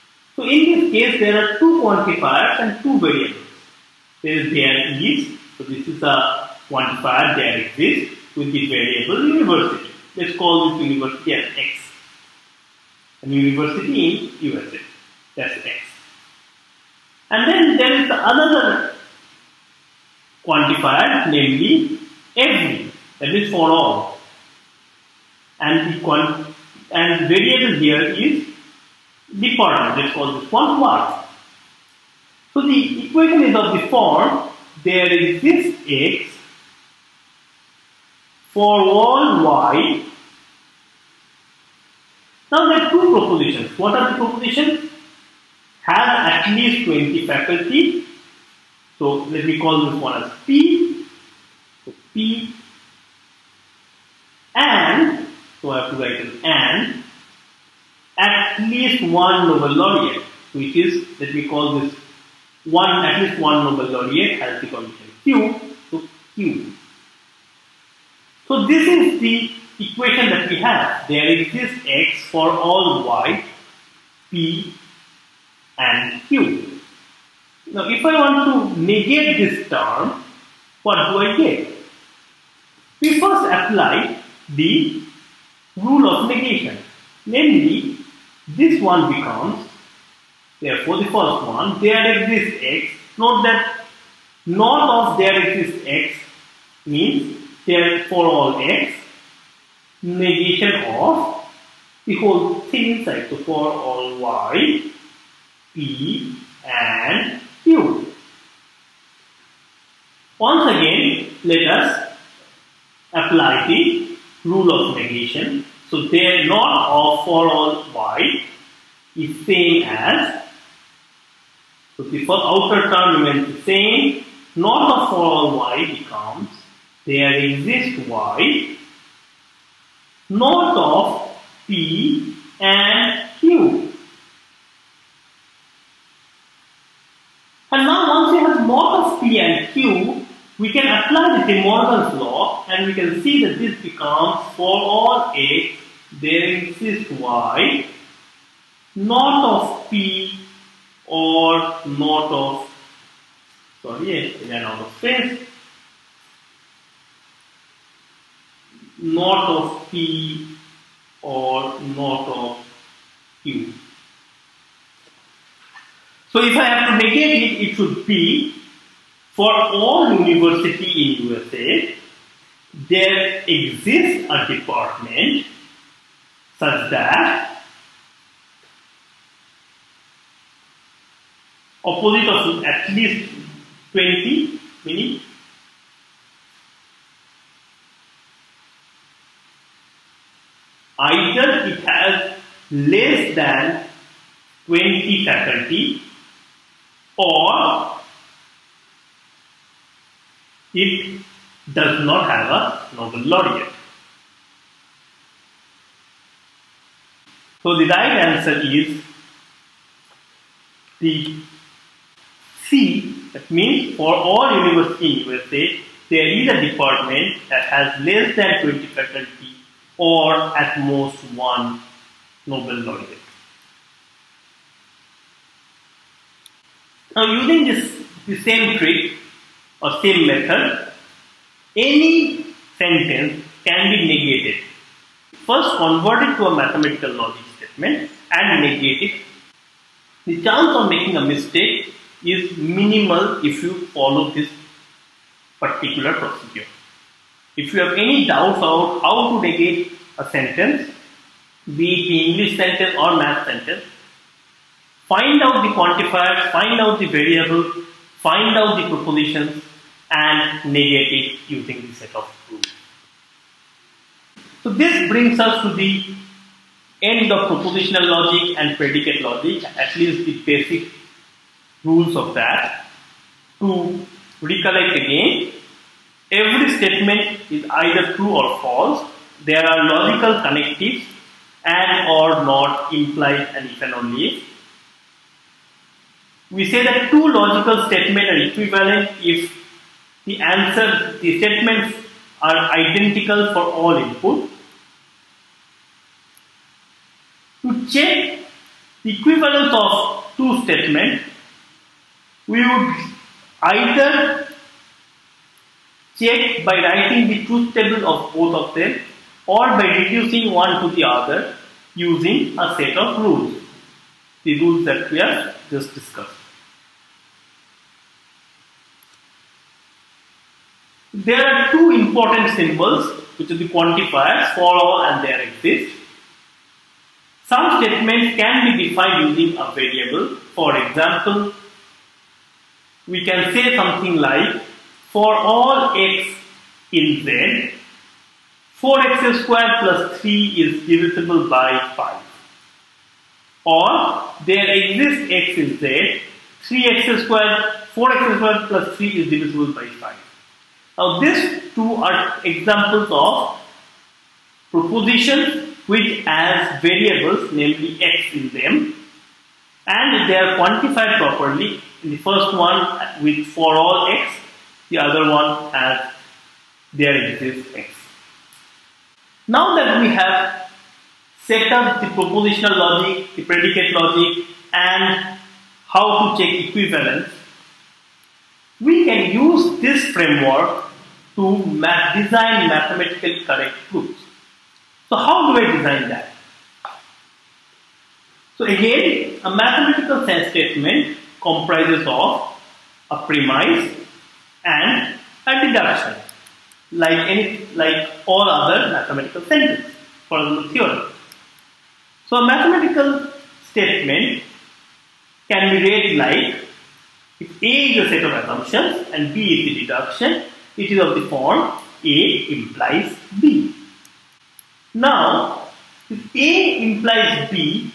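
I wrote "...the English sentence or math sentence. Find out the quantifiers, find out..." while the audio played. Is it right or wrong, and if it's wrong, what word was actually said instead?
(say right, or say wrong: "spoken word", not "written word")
right.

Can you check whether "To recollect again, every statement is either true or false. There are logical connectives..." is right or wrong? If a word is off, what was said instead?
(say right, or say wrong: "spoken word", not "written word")
right.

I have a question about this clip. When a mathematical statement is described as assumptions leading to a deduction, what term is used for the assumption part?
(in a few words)
premise.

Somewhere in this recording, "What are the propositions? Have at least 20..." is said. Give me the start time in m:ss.
0:43.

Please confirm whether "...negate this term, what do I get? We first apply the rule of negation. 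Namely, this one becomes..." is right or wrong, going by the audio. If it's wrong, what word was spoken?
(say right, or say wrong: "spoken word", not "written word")
right.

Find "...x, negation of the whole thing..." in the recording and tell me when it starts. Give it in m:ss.
1:38.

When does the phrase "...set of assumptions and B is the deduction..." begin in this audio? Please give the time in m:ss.
6:48.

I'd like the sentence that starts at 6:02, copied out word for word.
In the first one with for all x, the other one has there exists x.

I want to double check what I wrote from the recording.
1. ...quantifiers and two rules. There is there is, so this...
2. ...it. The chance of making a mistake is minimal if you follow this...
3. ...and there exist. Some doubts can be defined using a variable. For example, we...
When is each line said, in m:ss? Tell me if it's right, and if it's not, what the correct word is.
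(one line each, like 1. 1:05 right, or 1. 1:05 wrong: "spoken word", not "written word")
1. 0:01 wrong: "variables", not "rules"
2. 3:59 right
3. 5:25 wrong: "statements", not "doubts".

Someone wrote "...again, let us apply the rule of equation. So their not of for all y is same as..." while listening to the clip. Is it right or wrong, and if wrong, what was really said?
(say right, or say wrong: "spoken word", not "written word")
wrong: "negation", not "equation".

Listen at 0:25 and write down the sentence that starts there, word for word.
And the and variable here is department.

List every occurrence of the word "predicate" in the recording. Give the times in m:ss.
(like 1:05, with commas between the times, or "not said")
4:28, 6:13.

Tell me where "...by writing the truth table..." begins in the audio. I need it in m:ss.
5:06.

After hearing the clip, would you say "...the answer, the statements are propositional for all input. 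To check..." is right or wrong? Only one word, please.
wrong.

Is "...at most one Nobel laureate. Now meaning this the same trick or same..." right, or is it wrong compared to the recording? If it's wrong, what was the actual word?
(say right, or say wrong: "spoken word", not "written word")
wrong: "using", not "meaning".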